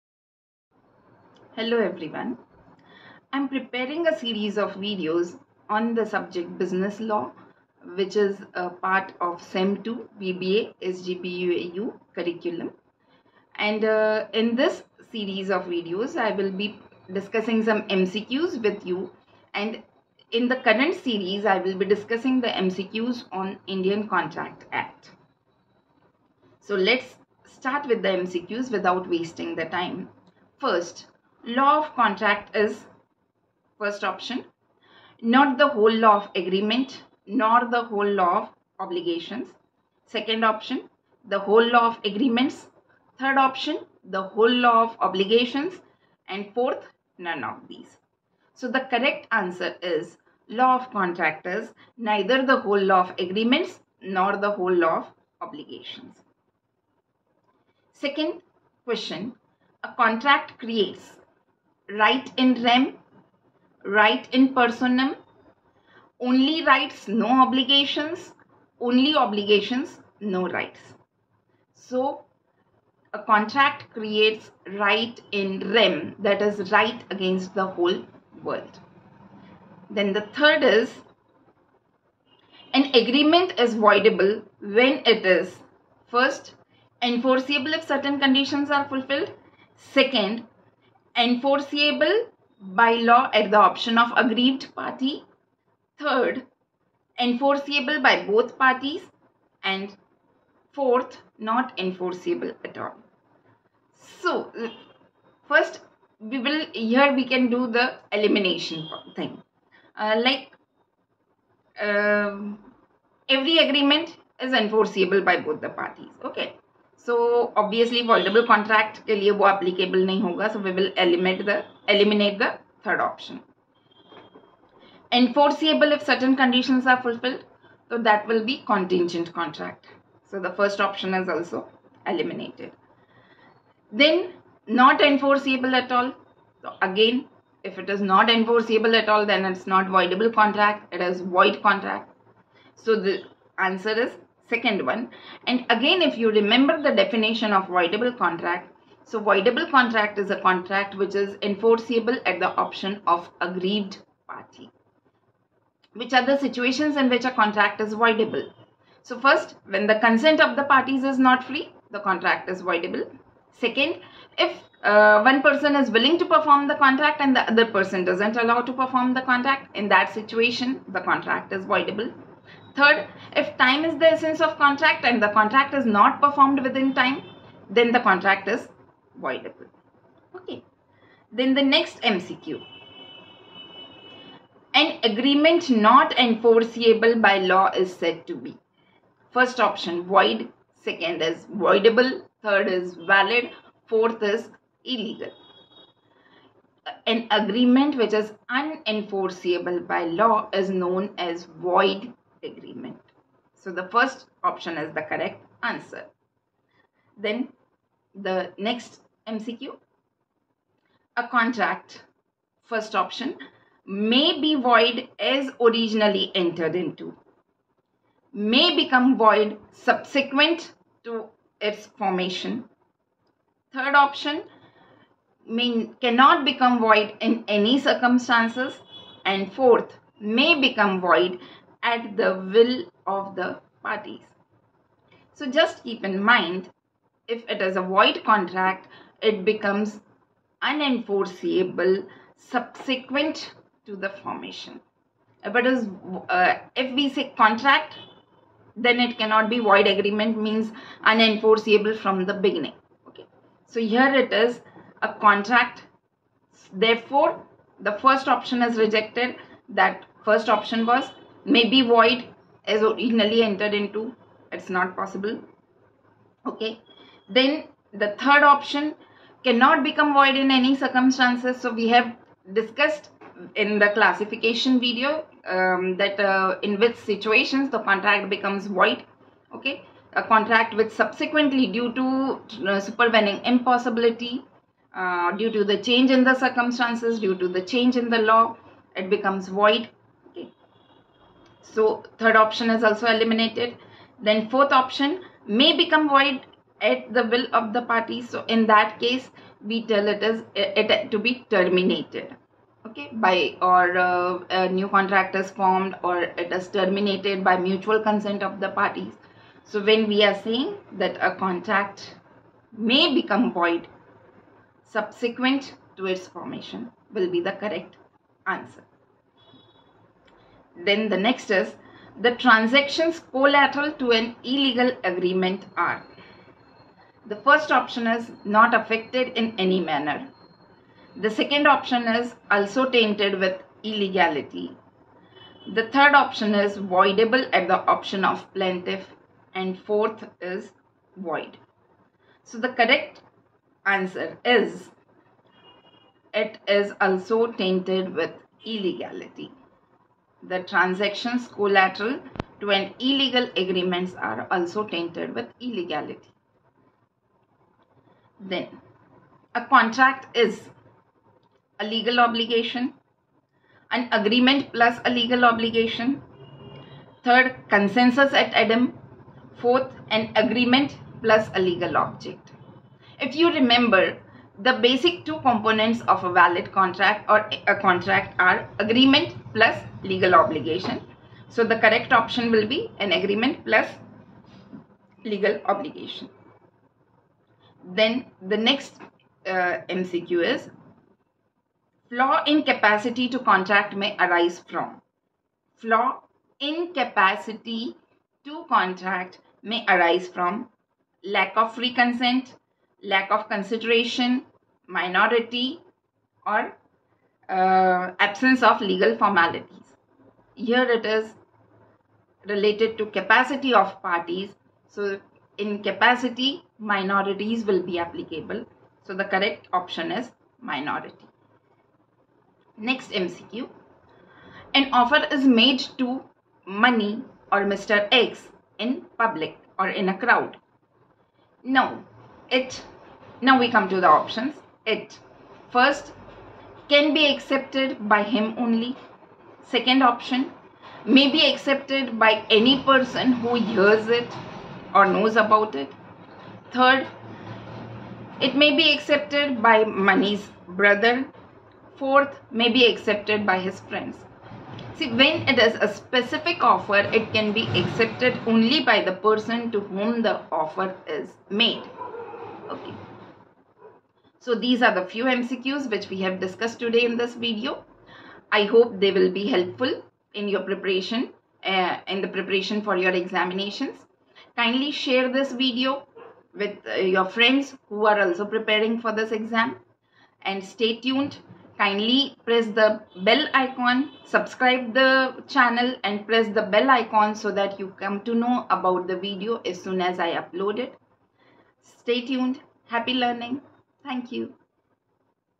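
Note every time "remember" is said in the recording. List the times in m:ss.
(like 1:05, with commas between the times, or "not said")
2:26, 6:13.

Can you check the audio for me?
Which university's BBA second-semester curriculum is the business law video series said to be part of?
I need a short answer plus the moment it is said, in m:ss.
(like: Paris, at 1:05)
SGPUAU, at 0:10.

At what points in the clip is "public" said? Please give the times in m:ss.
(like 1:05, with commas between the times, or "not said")
7:09.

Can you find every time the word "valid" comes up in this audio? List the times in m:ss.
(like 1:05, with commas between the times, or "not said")
3:12, 6:16.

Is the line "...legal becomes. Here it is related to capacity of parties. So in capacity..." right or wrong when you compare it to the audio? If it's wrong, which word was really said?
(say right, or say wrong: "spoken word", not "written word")
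wrong: "formalities", not "becomes".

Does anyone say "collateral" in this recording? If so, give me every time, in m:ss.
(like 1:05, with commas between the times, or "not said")
5:23, 5:51.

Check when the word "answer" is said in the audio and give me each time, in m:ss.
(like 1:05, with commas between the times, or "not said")
0:49, 2:23, 3:25, 5:18, 5:43.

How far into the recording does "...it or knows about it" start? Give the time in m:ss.
7:24.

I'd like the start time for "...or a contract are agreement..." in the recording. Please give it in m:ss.
6:17.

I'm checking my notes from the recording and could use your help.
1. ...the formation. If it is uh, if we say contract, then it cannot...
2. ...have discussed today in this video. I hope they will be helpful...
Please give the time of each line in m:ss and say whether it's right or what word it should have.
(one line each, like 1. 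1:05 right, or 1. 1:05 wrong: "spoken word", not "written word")
1. 4:03 right
2. 7:46 right.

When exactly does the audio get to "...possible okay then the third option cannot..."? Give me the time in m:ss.
4:24.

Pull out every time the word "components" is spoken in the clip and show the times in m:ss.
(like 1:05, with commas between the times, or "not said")
6:15.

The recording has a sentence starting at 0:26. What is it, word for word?
So let's start with the MCQs without wasting the time.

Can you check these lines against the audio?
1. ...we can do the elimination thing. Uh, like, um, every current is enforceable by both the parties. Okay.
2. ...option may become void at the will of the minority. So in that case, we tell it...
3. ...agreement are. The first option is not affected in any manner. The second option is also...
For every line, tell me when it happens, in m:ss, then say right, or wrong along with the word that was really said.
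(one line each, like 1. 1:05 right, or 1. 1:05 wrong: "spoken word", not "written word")
1. 1:47 wrong: "agreement", not "current"
2. 4:54 wrong: "party", not "minority"
3. 5:25 right.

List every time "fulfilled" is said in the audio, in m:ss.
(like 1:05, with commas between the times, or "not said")
1:28, 2:07.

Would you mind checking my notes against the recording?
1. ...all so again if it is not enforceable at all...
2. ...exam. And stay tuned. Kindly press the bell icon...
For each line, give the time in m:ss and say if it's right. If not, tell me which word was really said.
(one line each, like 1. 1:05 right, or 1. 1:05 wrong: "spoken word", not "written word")
1. 2:15 right
2. 7:59 right.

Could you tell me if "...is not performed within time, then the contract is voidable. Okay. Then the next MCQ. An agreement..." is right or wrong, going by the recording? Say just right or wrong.
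right.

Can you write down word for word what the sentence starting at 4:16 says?
Therefore, the first option is rejected.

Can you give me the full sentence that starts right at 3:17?
An agreement which is unenforceable by law is known as void agreement.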